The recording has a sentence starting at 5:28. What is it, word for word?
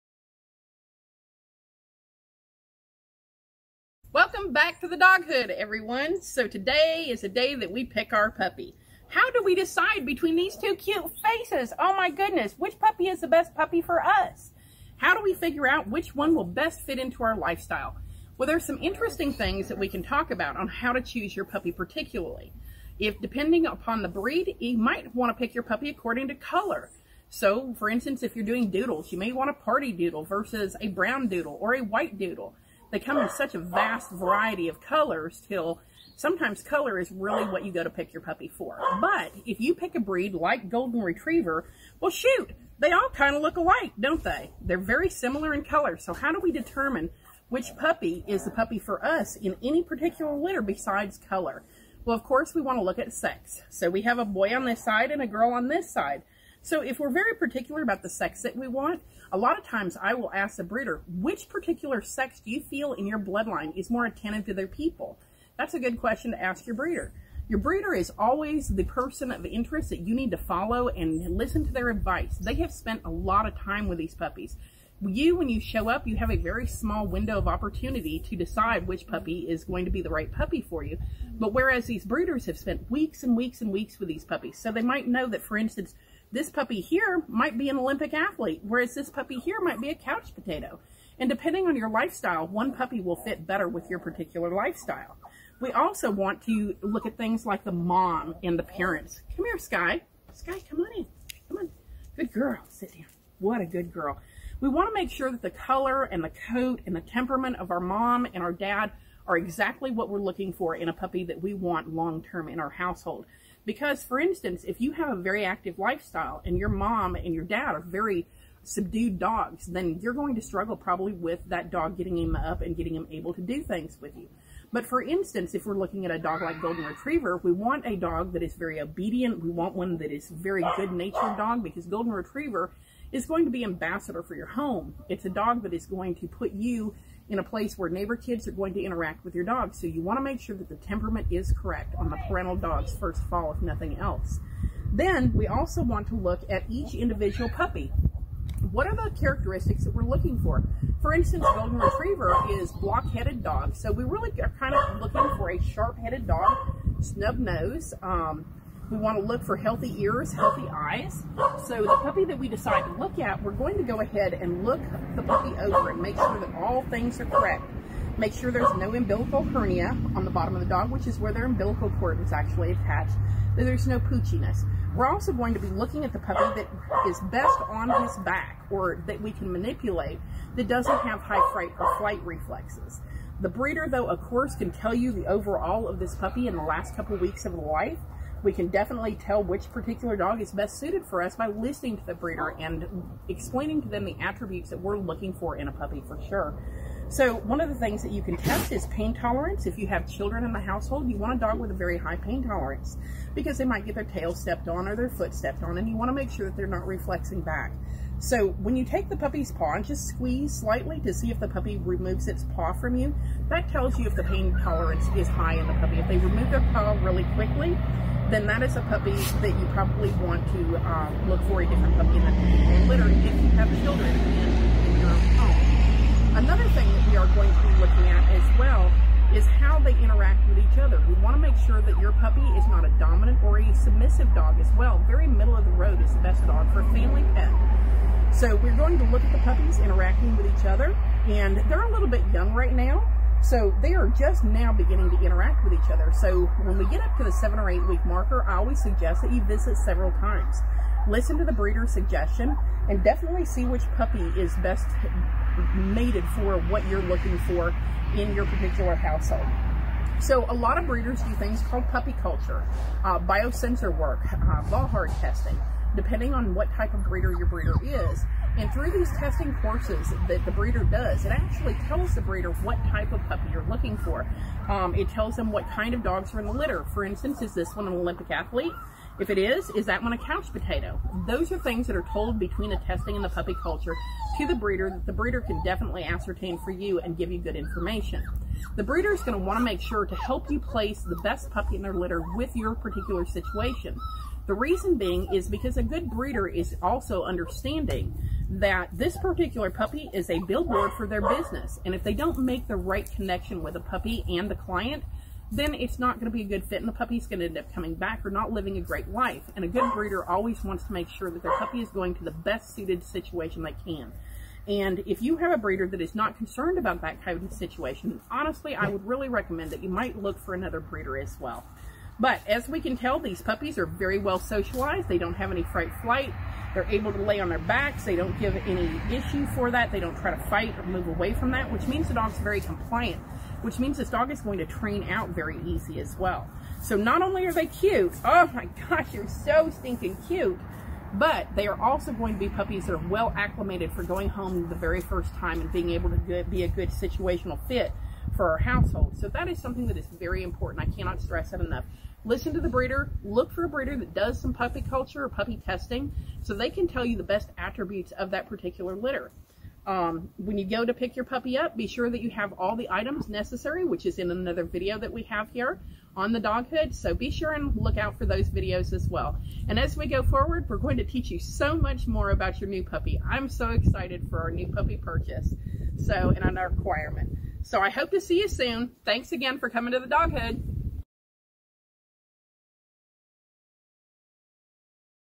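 They don't give any issue for that.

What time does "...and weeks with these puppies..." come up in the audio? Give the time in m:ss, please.
1:23.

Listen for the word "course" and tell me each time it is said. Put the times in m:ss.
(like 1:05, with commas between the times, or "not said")
0:52, 3:04, 4:29.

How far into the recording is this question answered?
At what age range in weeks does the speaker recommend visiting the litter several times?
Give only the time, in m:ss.
4:07.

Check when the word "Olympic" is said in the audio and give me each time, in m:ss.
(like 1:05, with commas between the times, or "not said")
1:27, 4:37.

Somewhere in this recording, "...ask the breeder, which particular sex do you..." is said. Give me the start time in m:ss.
1:00.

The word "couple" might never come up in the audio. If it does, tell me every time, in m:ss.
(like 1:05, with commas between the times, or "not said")
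3:06.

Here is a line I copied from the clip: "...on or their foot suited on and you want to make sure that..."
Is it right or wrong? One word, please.
wrong.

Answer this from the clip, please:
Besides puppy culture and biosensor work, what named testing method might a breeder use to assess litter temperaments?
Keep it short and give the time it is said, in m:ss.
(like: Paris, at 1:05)
Volhard testing, at 4:24.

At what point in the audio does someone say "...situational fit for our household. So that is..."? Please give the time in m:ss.
5:46.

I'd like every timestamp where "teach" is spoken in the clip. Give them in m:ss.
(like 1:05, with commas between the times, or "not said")
6:11.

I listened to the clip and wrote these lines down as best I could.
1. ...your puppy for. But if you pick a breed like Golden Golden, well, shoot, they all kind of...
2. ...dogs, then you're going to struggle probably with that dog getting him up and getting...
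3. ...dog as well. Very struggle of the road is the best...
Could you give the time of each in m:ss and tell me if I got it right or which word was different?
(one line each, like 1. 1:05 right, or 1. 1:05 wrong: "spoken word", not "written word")
1. 0:38 wrong: "Retriever", not "Golden"
2. 1:59 right
3. 3:54 wrong: "middle", not "struggle".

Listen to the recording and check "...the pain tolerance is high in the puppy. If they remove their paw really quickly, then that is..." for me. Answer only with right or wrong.
right.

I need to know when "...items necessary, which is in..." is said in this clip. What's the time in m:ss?
6:02.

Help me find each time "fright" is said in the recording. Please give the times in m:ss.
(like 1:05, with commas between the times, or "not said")
3:01, 5:25.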